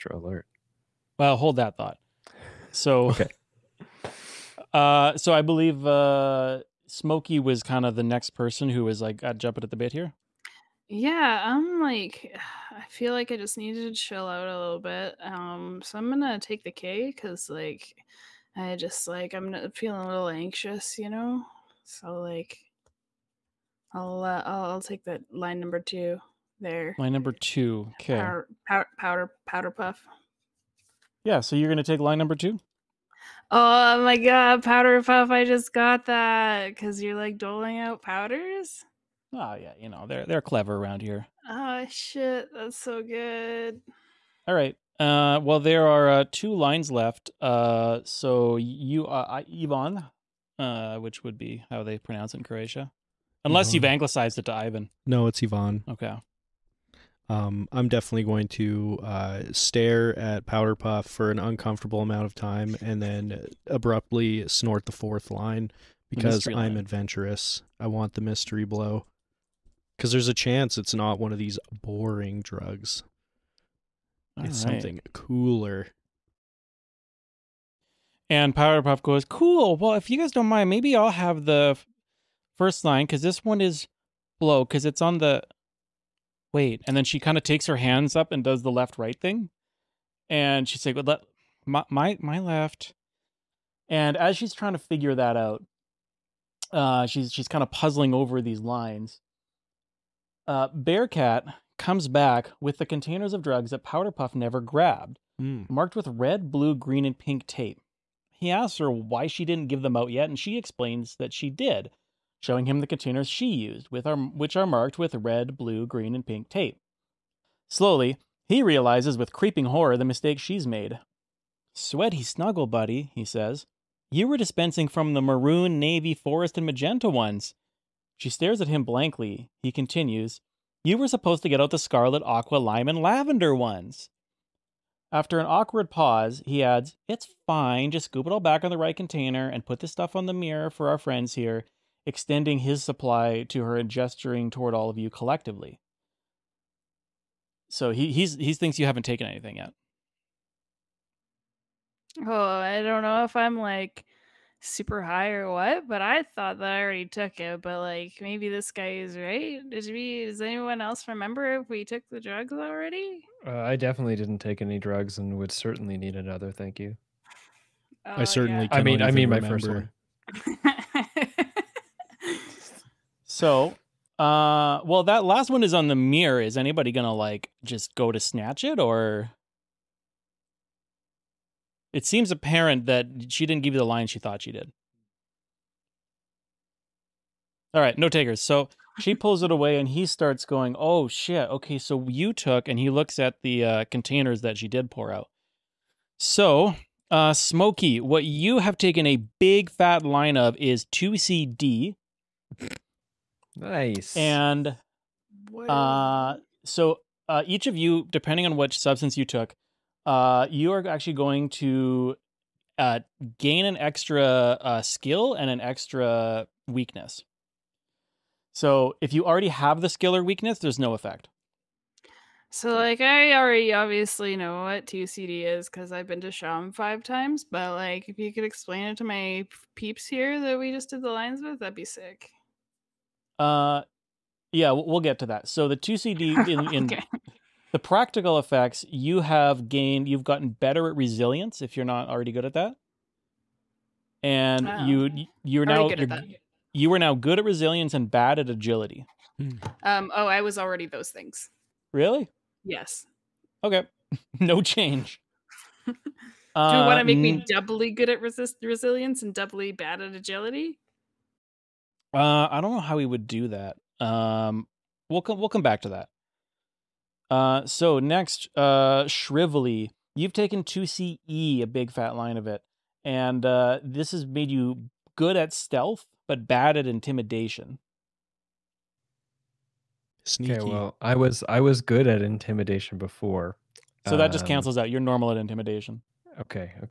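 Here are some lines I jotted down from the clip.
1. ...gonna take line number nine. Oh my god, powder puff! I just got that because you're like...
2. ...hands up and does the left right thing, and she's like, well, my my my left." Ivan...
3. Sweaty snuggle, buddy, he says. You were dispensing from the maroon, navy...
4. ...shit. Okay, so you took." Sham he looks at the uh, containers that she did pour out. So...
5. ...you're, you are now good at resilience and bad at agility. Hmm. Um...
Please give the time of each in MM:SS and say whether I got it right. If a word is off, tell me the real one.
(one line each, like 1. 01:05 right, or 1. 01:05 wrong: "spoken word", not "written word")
1. 00:31 wrong: "two", not "nine"
2. 01:27 wrong: "And", not "Ivan"
3. 02:01 right
4. 03:11 wrong: "And", not "Sham"
5. 04:05 right.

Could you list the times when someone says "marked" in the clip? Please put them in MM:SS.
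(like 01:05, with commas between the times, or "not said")
01:45, 01:54.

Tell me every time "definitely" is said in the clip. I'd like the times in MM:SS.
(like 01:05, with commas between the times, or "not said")
00:57, 02:43.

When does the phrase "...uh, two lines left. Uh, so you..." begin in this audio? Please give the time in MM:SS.
00:46.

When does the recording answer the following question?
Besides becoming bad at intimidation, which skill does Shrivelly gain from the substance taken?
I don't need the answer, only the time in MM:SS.
04:35.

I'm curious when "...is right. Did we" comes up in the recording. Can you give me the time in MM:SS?
02:38.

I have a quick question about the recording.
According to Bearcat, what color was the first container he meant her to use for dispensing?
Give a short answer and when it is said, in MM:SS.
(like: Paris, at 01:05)
Scarlet, at 02:11.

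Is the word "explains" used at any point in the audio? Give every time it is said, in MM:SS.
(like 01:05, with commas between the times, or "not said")
01:50, 03:48.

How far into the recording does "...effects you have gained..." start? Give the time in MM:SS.
03:58.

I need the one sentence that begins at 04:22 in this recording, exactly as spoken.
Uh, I don't know how we would do that.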